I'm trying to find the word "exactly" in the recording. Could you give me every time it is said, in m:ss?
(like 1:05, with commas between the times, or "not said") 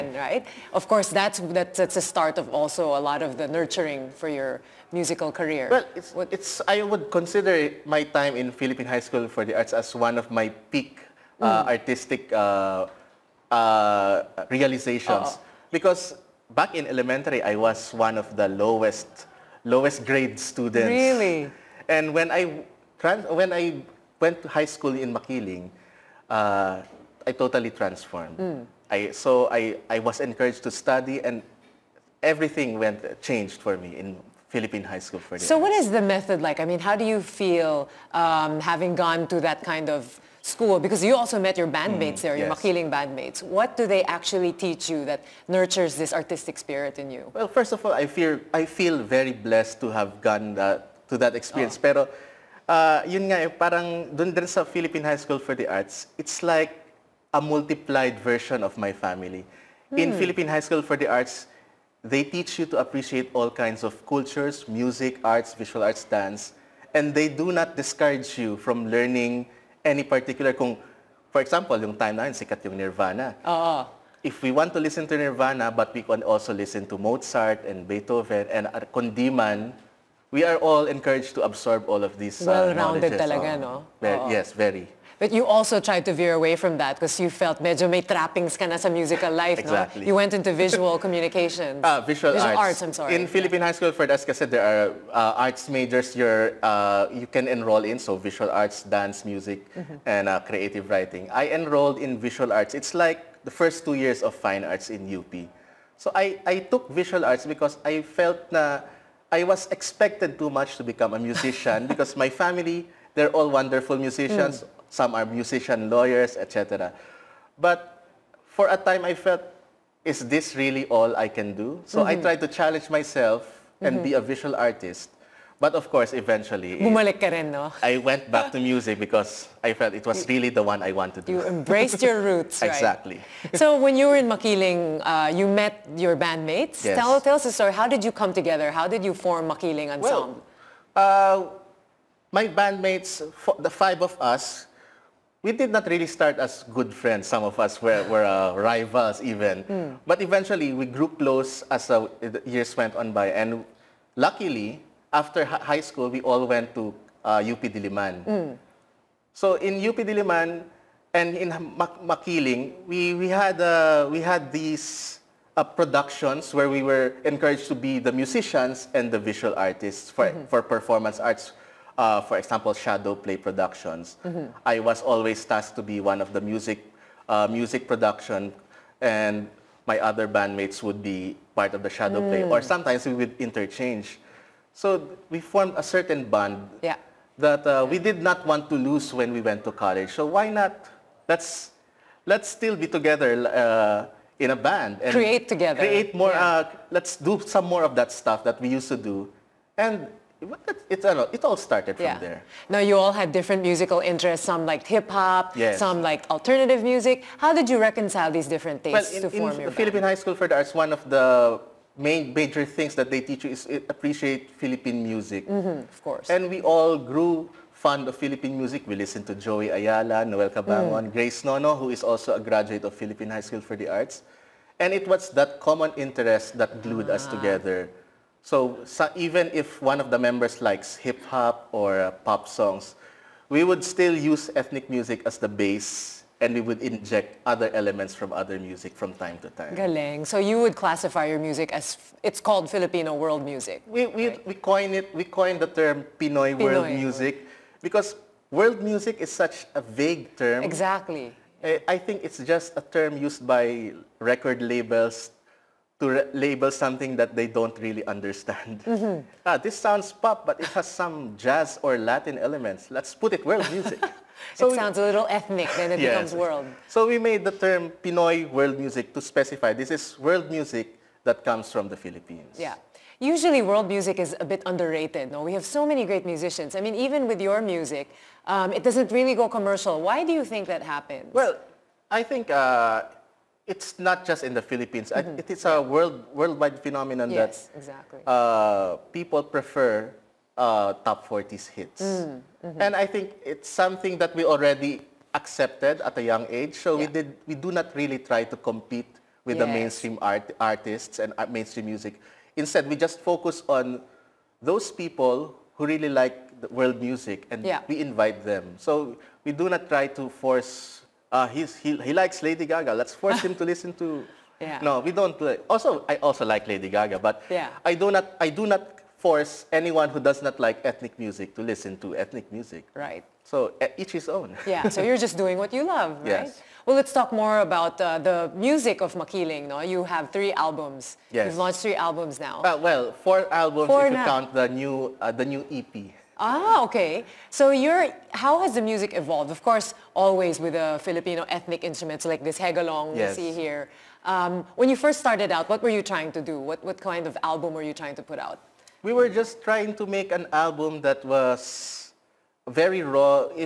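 1:29, 2:12, 4:10, 4:47.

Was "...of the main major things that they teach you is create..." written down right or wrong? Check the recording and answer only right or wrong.
wrong.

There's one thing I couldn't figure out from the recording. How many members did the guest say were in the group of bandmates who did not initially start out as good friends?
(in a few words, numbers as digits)
5.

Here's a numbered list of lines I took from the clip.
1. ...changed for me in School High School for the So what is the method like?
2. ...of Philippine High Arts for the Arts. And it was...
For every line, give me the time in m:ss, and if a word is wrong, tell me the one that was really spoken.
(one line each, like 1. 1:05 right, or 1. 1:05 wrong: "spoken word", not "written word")
1. 0:33 wrong: "Philippine", not "School"
2. 3:42 wrong: "School", not "Arts".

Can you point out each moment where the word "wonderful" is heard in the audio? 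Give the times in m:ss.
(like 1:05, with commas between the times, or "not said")
1:53.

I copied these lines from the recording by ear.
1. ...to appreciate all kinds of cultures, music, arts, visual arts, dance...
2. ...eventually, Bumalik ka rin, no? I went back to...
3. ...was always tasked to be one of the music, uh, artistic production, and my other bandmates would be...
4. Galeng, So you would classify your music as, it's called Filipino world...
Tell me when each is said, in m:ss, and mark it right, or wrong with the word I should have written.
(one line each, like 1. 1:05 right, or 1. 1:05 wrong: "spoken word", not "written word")
1. 1:02 right
2. 2:06 right
3. 2:54 wrong: "music", not "artistic"
4. 3:59 right.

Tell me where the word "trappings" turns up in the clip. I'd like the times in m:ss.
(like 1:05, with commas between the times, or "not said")
1:28.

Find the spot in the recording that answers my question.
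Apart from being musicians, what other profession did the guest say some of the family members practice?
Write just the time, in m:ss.
1:55.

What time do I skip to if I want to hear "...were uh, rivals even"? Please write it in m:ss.
2:28.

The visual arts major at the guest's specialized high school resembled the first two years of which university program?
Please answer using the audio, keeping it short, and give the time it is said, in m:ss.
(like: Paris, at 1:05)
fine arts, at 1:44.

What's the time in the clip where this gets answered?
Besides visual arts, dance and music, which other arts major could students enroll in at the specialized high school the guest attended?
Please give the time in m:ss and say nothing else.
1:40.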